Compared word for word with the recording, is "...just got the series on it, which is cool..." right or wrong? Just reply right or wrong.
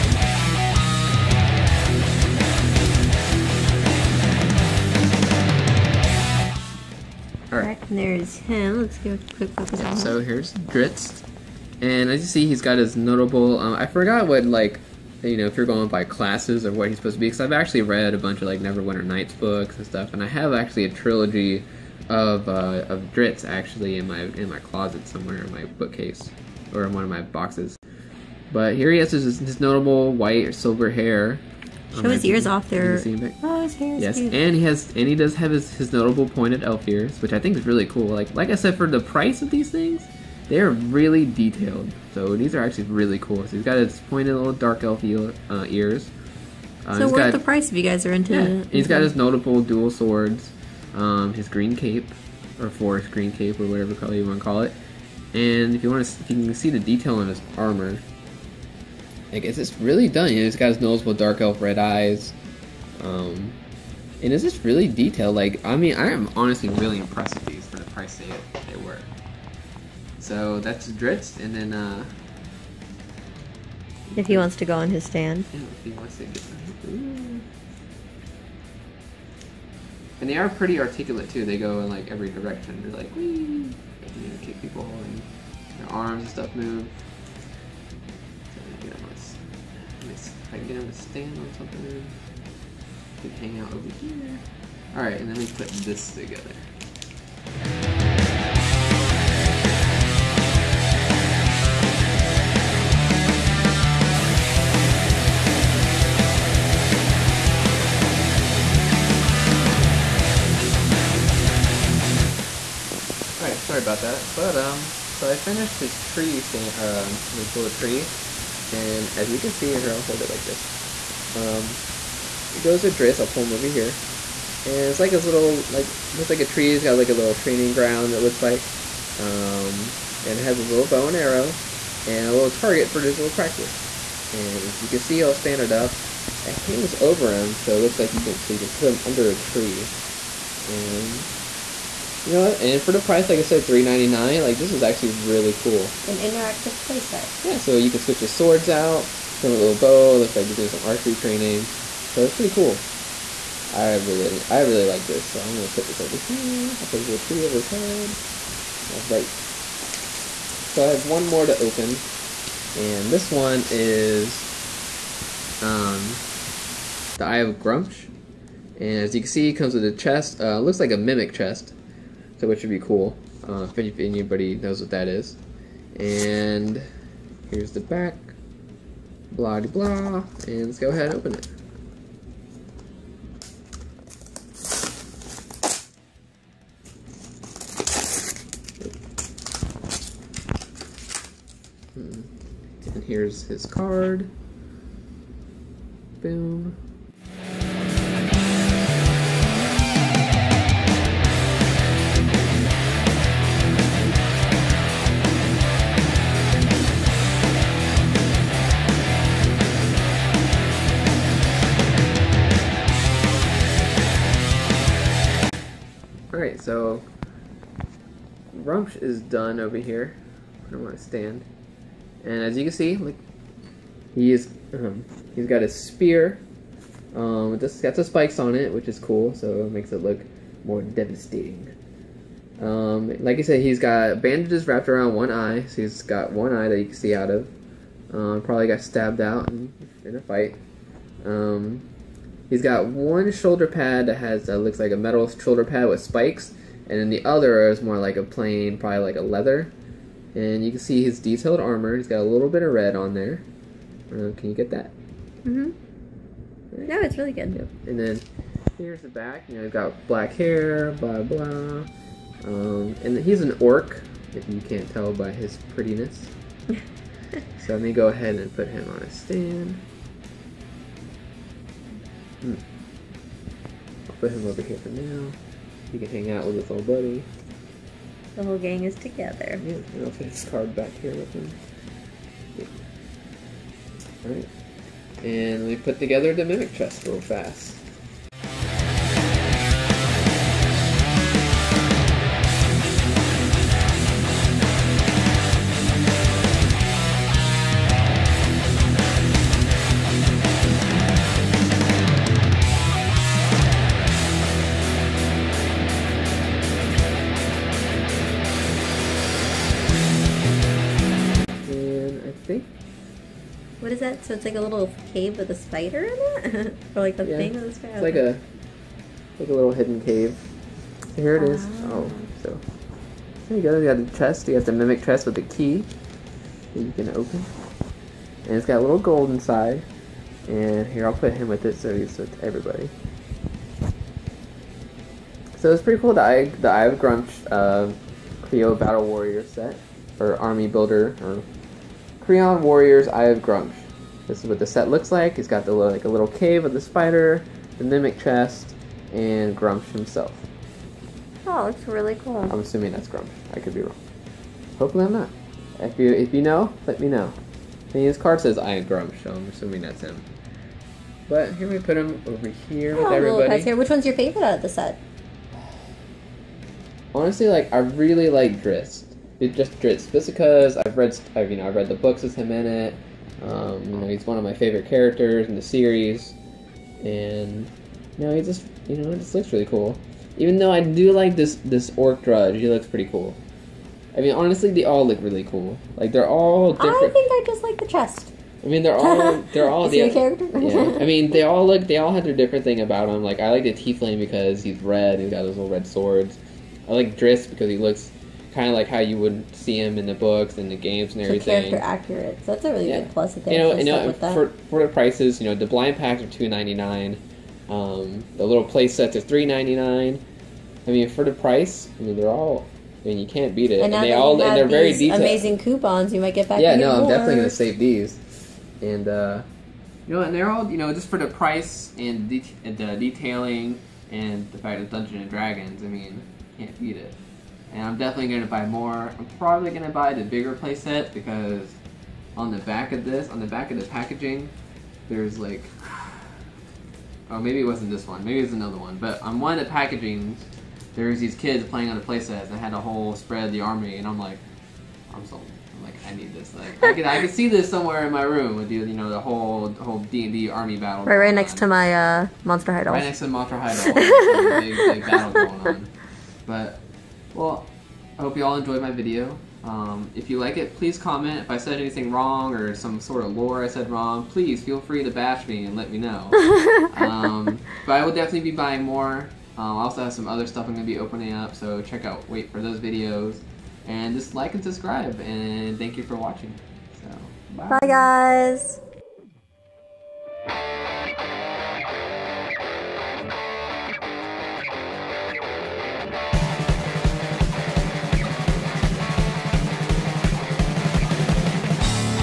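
wrong.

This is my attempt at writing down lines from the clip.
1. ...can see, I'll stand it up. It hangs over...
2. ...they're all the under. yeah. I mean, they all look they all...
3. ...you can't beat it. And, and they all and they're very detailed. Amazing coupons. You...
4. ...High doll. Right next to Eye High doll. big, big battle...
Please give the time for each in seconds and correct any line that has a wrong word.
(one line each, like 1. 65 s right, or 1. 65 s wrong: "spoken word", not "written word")
1. 134 s right
2. 389 s wrong: "character", not "under"
3. 413 s right
4. 452 s wrong: "Monster", not "Eye".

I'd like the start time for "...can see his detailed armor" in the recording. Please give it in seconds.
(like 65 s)
250 s.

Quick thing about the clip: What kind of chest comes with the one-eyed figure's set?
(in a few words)
A mimic chest.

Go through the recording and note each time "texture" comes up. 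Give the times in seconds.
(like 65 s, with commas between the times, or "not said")
not said.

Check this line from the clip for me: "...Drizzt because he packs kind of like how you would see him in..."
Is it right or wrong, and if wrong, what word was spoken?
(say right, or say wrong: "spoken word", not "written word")
wrong: "looks", not "packs".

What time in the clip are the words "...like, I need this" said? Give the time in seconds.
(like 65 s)
445 s.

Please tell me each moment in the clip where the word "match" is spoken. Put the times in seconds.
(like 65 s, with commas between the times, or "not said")
not said.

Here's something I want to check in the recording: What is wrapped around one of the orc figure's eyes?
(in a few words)
Bandages.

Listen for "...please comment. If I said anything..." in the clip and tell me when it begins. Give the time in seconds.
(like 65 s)
460 s.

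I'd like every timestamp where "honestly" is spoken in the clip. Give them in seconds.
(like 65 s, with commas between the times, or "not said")
66 s, 367 s, 384 s.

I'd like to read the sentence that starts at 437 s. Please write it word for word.
Oh, maybe it wasn't this one.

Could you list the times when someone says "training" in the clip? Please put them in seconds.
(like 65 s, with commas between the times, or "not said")
127 s, 151 s.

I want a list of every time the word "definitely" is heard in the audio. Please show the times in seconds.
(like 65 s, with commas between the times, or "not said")
417 s, 427 s, 468 s.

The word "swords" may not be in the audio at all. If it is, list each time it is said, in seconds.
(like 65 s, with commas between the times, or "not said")
49 s, 148 s, 395 s.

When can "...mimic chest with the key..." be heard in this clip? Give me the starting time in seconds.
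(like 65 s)
324 s.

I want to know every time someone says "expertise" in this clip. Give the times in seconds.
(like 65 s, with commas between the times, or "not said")
not said.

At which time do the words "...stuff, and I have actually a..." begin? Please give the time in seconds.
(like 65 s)
19 s.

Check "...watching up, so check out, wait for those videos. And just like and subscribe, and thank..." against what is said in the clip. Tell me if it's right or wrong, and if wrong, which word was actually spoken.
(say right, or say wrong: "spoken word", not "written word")
wrong: "opening", not "watching".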